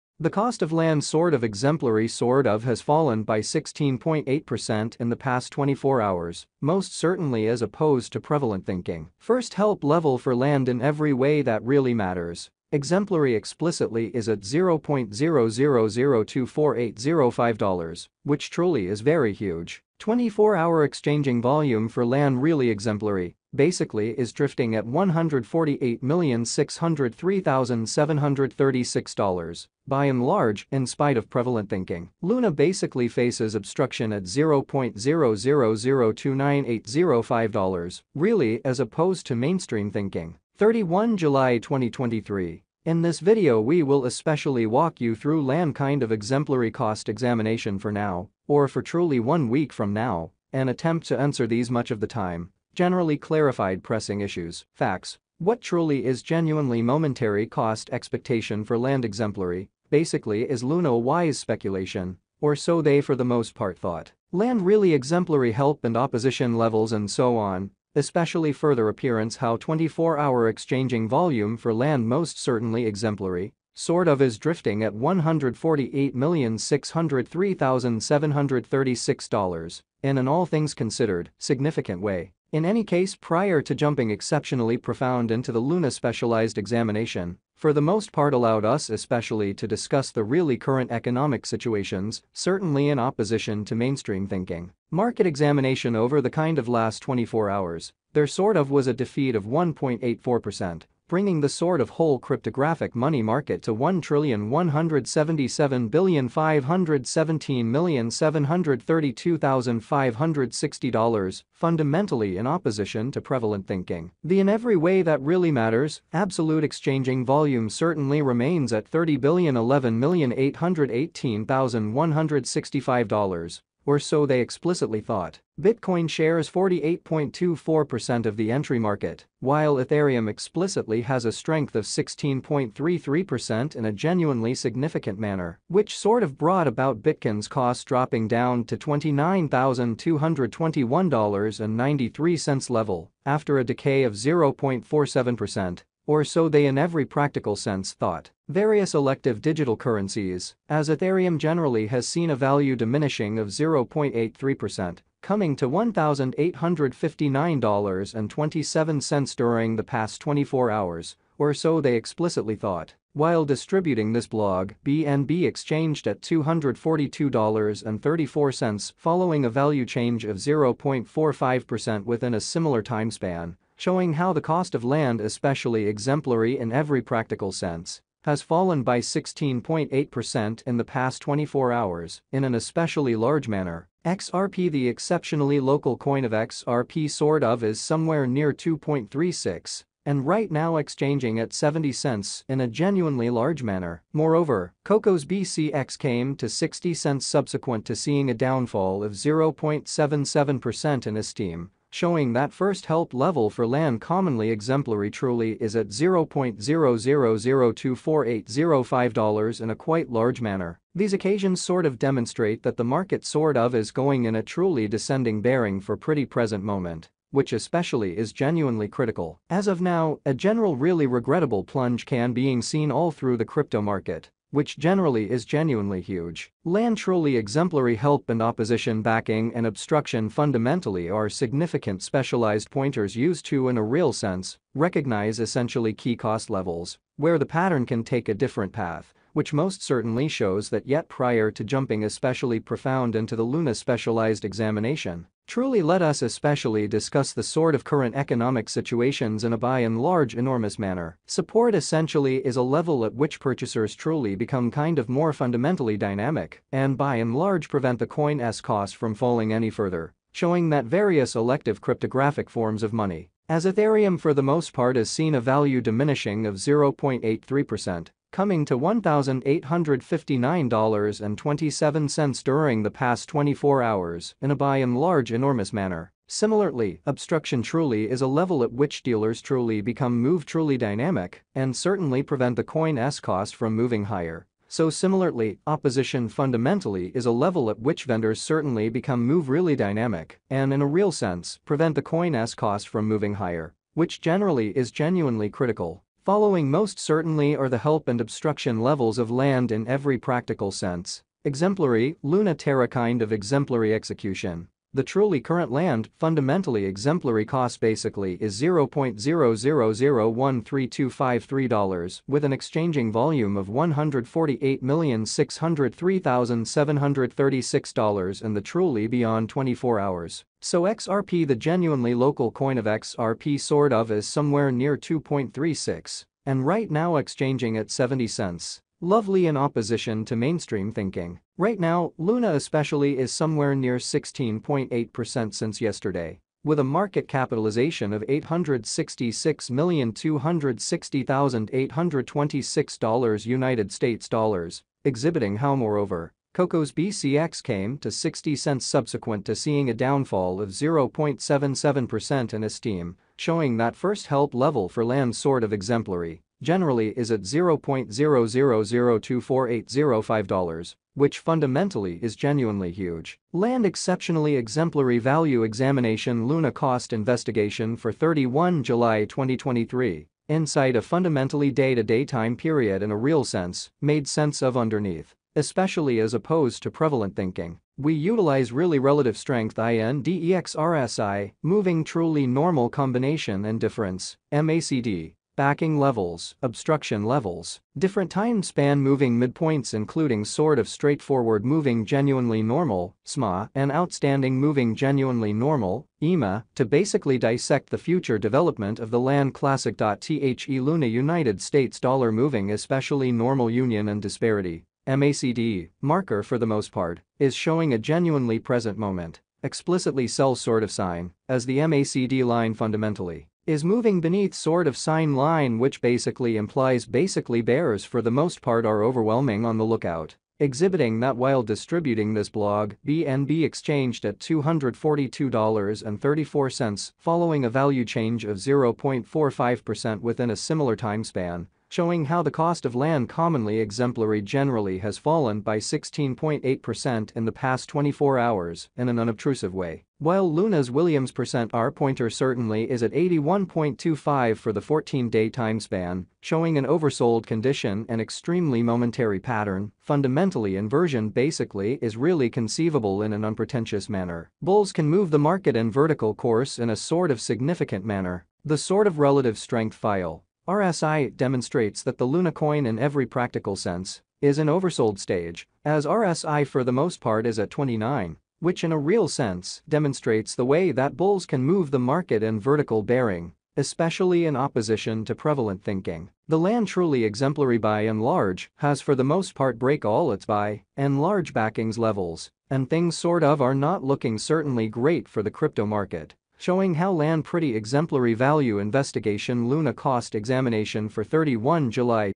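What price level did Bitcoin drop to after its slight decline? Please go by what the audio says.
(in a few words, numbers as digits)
$29,221.93.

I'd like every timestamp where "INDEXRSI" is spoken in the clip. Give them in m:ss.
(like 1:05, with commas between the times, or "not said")
6:19.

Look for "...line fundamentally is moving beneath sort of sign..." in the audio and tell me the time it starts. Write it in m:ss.
6:52.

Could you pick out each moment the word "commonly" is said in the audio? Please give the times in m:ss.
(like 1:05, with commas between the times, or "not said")
3:23, 7:13.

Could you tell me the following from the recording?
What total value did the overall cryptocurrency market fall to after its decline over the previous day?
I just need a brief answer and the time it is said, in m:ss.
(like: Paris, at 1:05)
1,177,517,732,560, at 1:43.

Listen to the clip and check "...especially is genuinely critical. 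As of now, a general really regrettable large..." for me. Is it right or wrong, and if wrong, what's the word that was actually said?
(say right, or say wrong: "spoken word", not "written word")
wrong: "plunge", not "large".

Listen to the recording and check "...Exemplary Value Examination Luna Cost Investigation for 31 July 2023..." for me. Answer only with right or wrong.
right.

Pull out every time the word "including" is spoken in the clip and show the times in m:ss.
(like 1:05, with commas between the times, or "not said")
6:29.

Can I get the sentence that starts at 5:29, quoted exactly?
Lovely in opposition to mainstream thinking.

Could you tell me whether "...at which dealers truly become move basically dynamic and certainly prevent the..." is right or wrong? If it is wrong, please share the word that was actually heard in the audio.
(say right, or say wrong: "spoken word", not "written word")
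wrong: "truly", not "basically".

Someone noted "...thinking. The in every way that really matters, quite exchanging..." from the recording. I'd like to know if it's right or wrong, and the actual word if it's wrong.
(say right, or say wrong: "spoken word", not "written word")
wrong: "absolute", not "quite".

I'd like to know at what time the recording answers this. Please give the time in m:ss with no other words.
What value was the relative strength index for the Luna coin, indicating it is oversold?
7:47.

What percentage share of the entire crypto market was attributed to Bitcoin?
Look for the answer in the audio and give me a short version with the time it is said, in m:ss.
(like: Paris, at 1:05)
48.24%, at 2:06.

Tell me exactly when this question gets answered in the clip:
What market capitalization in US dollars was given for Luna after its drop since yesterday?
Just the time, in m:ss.
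5:38.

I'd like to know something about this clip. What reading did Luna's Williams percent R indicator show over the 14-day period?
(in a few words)
81.25.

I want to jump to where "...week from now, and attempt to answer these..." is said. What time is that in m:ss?
0:49.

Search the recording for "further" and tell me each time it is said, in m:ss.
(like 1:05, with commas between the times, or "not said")
1:08, 4:19.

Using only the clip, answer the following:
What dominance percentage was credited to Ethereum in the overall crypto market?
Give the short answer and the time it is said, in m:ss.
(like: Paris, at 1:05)
16.33%, at 2:11.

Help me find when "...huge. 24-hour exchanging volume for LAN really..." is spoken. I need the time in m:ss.
0:19.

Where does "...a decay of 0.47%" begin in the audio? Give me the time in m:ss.
2:23.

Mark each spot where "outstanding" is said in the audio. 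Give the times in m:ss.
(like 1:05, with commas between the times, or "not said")
6:33.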